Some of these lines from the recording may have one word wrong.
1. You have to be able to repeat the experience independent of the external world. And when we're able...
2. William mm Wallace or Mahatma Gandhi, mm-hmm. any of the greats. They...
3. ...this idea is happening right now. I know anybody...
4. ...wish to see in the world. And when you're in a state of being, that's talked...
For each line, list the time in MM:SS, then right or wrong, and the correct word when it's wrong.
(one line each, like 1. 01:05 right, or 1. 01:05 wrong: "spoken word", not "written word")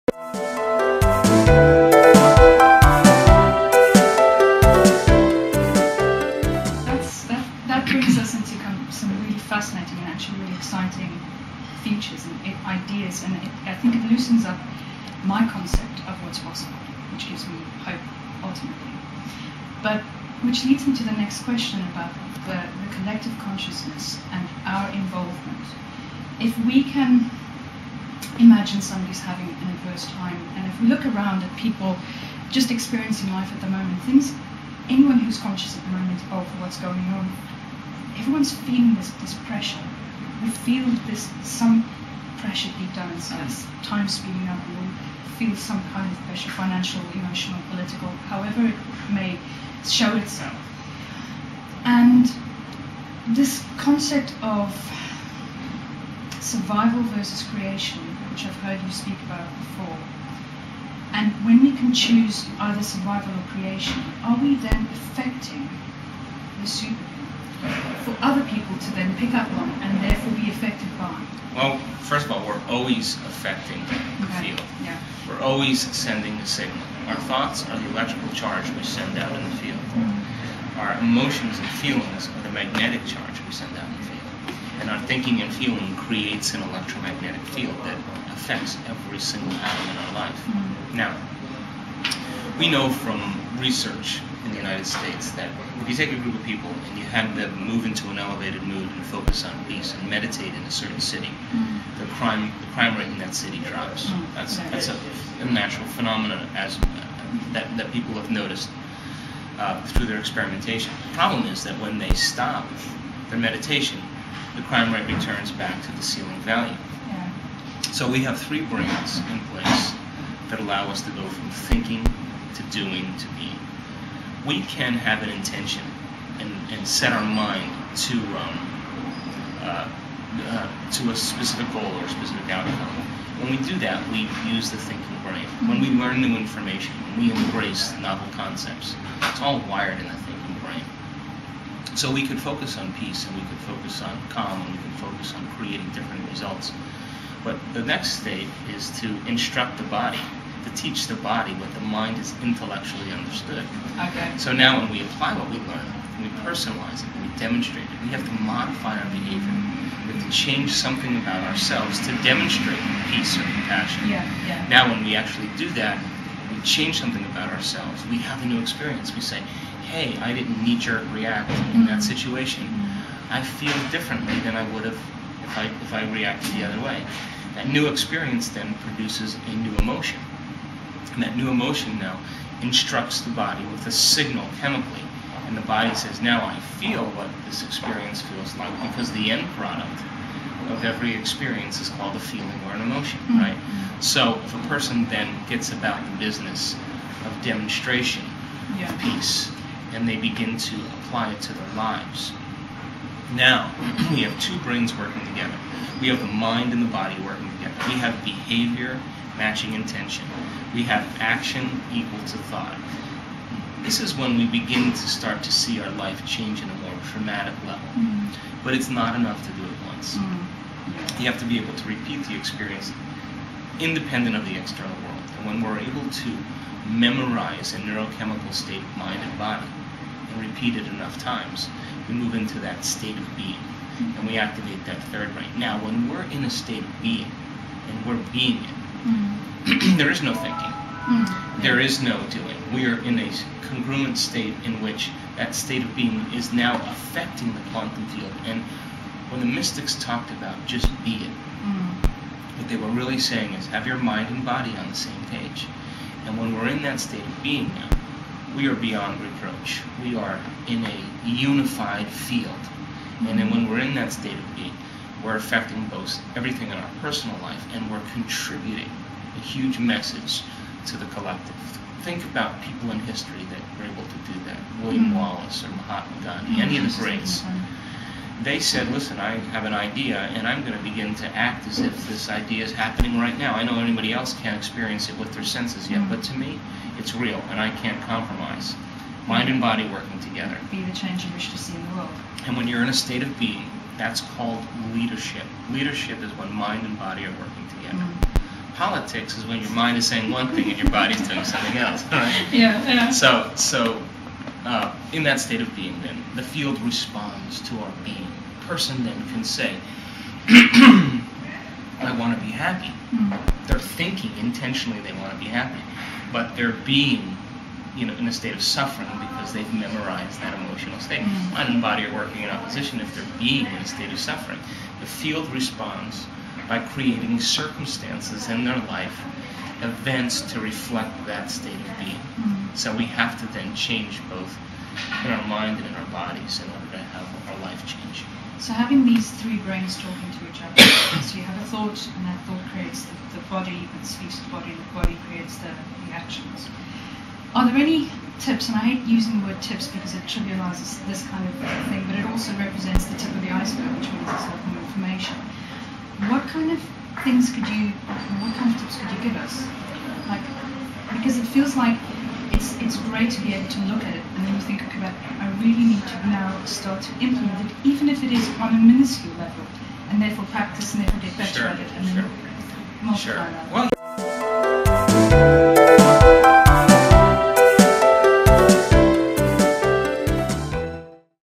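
1. 03:41 right
2. 04:34 right
3. 04:42 right
4. 04:51 wrong: "called", not "talked".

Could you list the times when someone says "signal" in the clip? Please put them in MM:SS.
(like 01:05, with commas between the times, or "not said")
01:16, 03:03.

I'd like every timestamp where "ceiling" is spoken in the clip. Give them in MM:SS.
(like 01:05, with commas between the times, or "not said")
01:56.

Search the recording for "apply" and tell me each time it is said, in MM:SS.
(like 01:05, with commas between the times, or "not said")
02:35, 03:20.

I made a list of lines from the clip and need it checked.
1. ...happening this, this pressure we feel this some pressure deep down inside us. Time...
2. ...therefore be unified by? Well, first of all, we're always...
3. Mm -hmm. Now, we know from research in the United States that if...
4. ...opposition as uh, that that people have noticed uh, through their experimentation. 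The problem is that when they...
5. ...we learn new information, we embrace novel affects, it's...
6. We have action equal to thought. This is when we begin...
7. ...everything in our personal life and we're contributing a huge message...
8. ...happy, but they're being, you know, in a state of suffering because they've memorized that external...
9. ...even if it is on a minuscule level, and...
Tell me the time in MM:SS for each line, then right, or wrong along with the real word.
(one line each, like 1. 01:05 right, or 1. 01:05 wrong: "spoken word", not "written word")
1. 00:38 wrong: "feeling", not "happening"
2. 01:10 wrong: "affected", not "unified"
3. 01:30 right
4. 01:45 wrong: "phenomenon", not "opposition"
5. 02:15 wrong: "concepts", not "affects"
6. 03:30 right
7. 04:26 right
8. 05:15 wrong: "emotional", not "external"
9. 06:07 right.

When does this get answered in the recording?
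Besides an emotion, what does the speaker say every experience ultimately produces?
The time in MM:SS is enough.
03:12.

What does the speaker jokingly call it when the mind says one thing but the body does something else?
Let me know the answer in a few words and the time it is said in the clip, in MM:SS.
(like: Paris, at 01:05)
Politics, at 04:58.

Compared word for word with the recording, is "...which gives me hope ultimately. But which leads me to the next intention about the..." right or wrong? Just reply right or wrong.
wrong.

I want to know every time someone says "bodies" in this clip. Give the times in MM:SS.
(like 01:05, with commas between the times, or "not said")
05:36.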